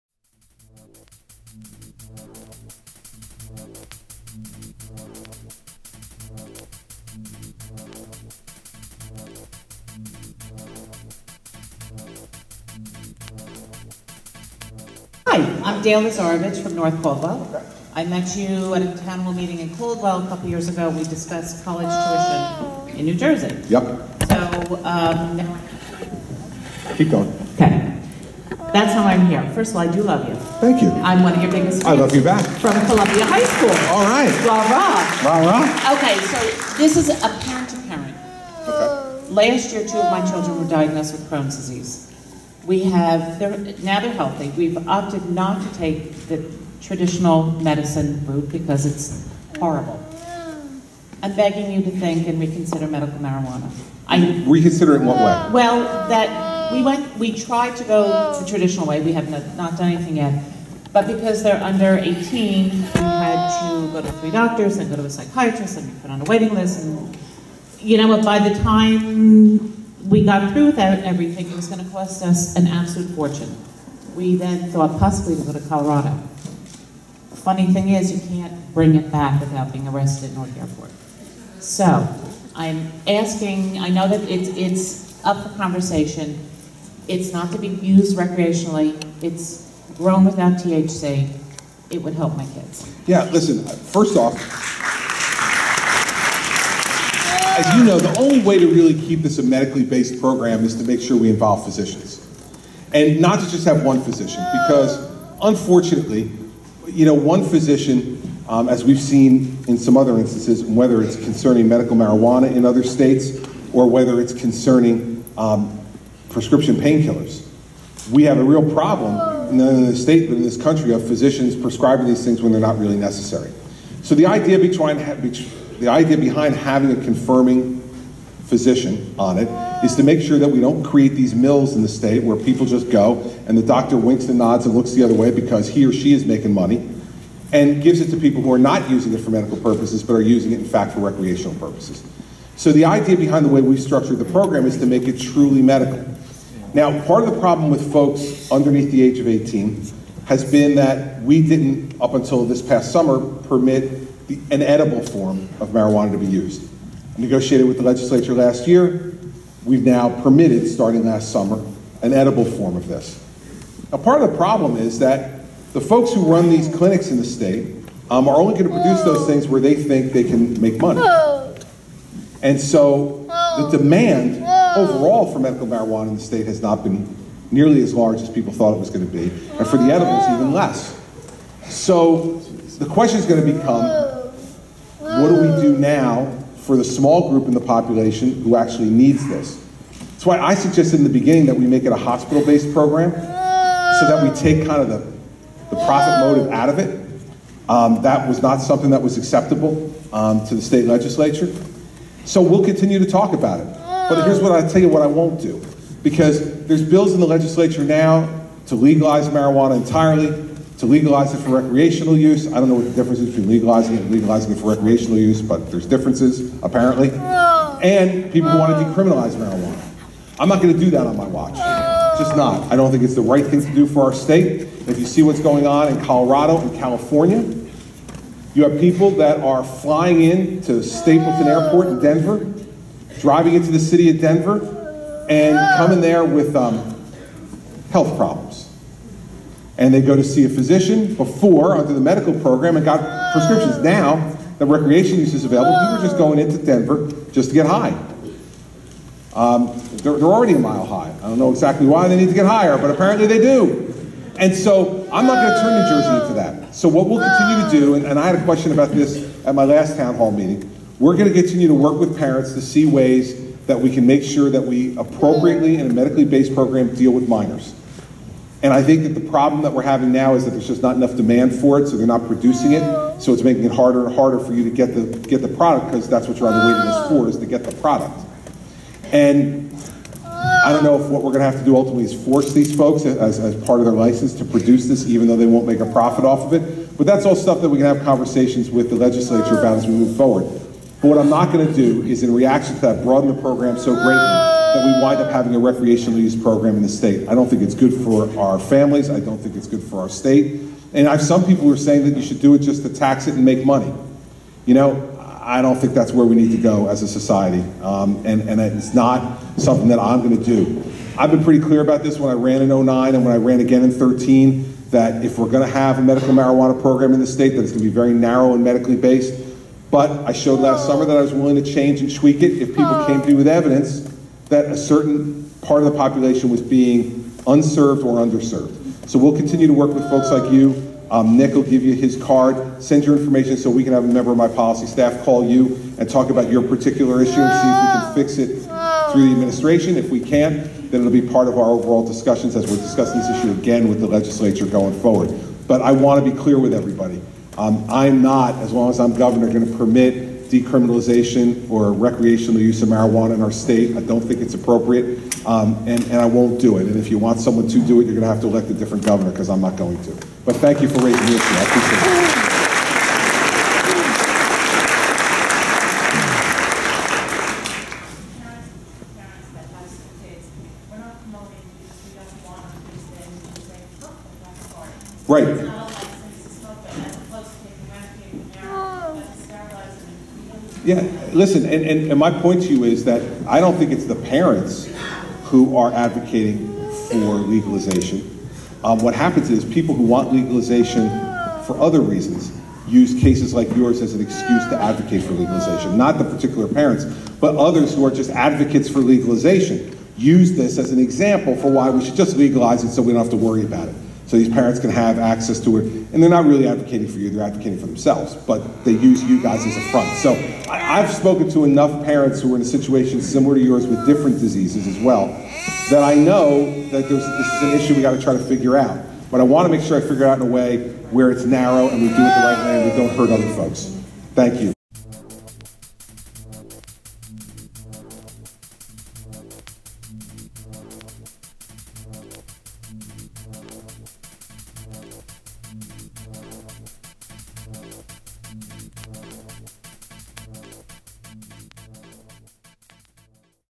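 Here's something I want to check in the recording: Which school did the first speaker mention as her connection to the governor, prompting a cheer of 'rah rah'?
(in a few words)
Columbia High School.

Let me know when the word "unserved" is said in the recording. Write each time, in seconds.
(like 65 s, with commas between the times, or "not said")
327 s.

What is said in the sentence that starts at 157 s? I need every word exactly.
negotiated with the legislature last year.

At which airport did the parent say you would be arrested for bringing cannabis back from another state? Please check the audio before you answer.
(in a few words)
Newark Airport.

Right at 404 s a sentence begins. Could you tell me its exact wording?
So these parents can have access to it.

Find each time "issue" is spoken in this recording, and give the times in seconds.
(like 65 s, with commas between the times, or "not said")
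337 s, 343 s, 361 s, 417 s.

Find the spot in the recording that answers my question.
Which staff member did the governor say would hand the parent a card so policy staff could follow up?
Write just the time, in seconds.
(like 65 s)
331 s.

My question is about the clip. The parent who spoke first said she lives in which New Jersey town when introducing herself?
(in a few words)
North Caldwell.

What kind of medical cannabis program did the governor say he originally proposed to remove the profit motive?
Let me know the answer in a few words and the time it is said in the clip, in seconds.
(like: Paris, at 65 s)
Hospital-based, at 191 s.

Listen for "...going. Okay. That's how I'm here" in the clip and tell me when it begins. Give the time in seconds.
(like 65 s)
27 s.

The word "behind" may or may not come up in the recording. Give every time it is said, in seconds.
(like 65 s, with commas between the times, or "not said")
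126 s, 143 s.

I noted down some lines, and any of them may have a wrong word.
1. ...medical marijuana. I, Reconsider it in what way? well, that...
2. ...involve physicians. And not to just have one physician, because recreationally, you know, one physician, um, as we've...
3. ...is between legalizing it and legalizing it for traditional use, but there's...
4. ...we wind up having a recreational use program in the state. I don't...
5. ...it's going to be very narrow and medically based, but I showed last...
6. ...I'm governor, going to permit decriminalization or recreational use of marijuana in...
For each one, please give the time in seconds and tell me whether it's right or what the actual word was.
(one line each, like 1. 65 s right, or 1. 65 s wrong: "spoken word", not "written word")
1. 52 s right
2. 101 s wrong: "unfortunately", not "recreationally"
3. 213 s wrong: "recreational", not "traditional"
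4. 294 s right
5. 317 s right
6. 348 s right.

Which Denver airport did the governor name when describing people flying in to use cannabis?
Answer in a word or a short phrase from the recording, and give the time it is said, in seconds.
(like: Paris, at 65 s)
Stapleton Airport, at 230 s.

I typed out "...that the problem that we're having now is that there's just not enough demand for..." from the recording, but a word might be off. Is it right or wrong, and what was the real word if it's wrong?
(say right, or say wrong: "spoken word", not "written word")
right.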